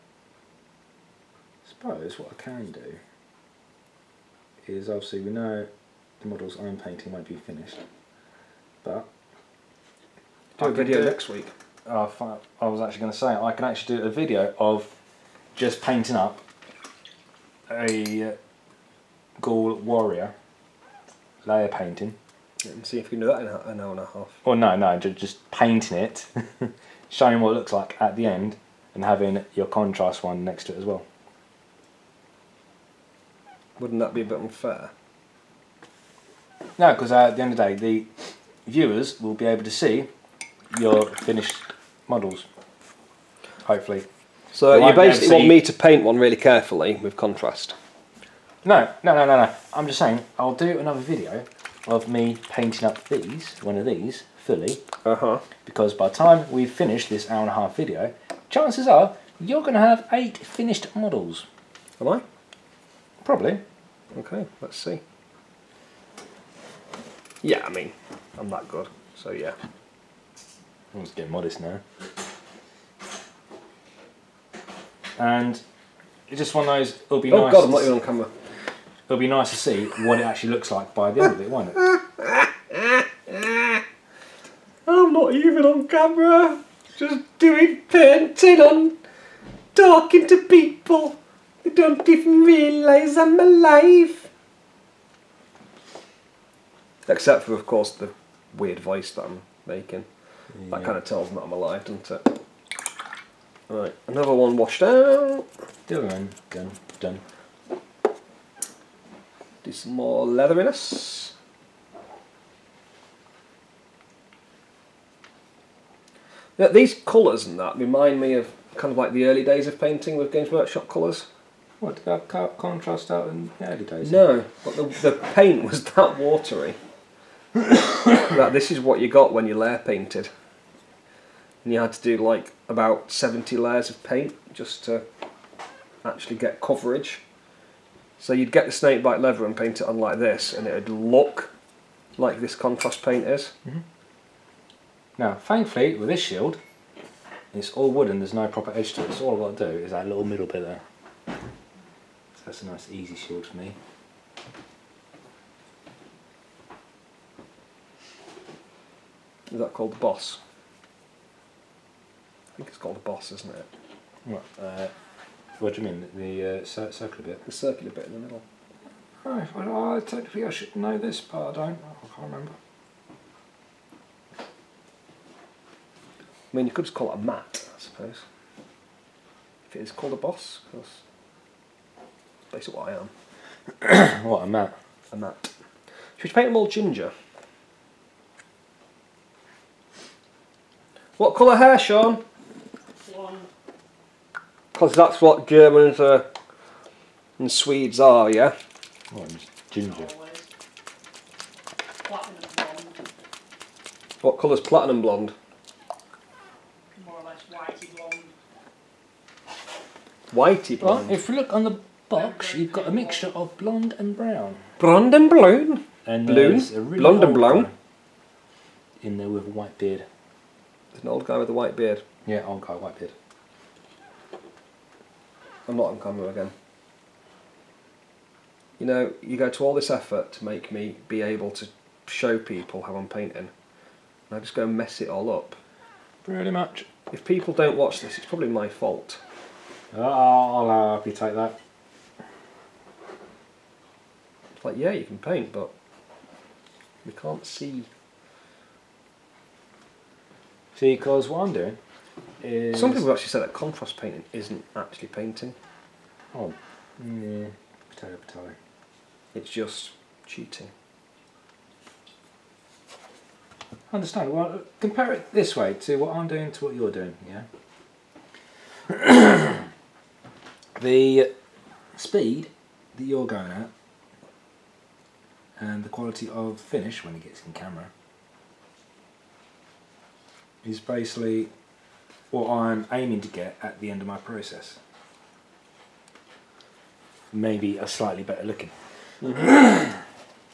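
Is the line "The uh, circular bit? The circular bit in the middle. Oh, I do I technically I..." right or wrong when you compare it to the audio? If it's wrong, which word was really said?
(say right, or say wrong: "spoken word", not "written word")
right.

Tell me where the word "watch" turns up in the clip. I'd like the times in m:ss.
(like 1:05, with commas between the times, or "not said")
3:57.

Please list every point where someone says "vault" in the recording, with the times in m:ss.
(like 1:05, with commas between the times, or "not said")
not said.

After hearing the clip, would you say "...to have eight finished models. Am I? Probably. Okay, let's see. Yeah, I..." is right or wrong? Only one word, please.
right.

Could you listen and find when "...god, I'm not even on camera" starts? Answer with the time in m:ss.
1:17.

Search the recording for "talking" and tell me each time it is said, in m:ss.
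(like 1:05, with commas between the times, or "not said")
1:29.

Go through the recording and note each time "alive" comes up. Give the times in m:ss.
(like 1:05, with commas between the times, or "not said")
1:33, 1:41.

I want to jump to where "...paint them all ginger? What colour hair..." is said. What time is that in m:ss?
3:06.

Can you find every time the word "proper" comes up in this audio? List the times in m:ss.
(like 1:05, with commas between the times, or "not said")
2:28.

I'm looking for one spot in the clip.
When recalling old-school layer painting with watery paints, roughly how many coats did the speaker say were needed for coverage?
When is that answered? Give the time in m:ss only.
2:13.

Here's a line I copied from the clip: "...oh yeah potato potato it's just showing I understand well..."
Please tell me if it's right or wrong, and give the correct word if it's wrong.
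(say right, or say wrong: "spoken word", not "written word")
wrong: "cheating", not "showing".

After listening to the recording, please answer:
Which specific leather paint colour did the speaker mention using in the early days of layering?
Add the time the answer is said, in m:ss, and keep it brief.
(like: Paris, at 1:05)
snakebite leather, at 2:18.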